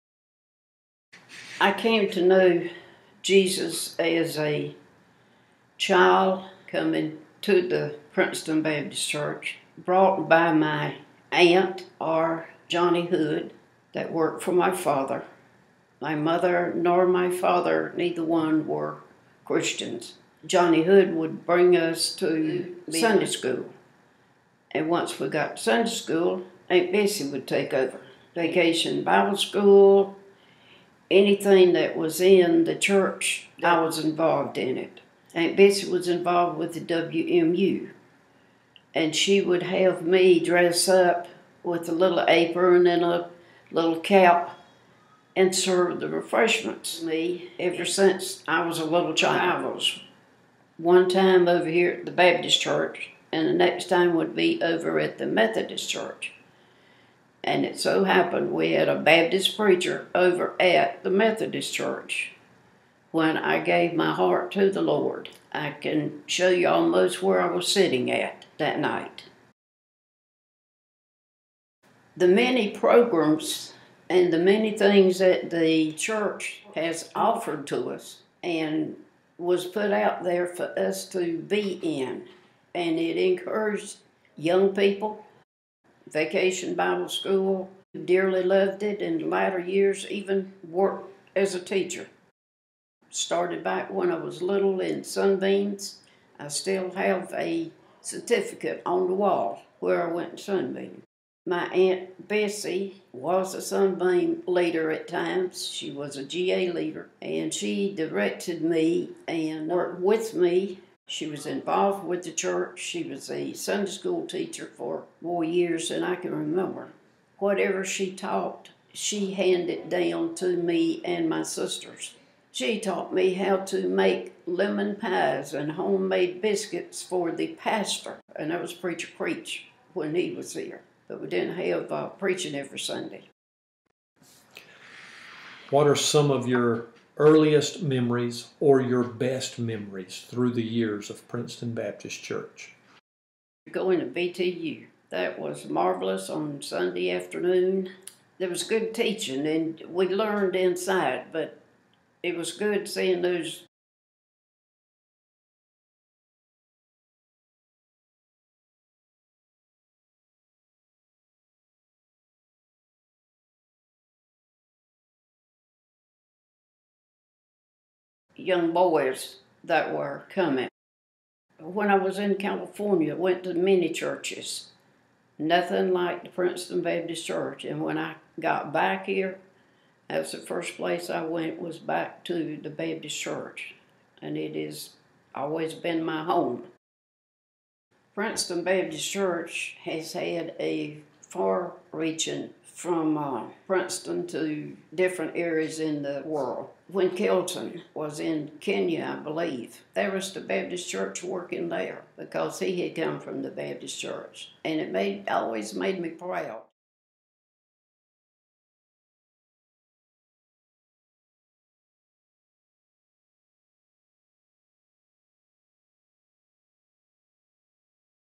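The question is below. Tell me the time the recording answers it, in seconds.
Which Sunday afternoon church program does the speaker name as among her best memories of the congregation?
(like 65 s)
144 s.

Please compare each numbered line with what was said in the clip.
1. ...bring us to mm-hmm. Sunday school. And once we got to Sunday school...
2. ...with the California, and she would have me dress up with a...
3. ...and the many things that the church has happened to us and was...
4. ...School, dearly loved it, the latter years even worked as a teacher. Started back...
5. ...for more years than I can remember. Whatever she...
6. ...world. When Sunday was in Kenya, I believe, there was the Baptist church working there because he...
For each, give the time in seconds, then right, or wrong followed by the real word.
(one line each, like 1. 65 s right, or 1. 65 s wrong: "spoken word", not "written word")
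1. 21 s right
2. 36 s wrong: "WMU", not "California"
3. 74 s wrong: "offered", not "happened"
4. 87 s right
5. 114 s right
6. 196 s wrong: "Kelton", not "Sunday".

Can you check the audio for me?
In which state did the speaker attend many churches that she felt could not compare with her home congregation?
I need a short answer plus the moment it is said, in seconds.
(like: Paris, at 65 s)
California, at 172 s.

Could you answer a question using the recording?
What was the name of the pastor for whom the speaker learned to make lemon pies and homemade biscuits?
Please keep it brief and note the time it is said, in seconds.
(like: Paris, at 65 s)
Preacher Creech, at 128 s.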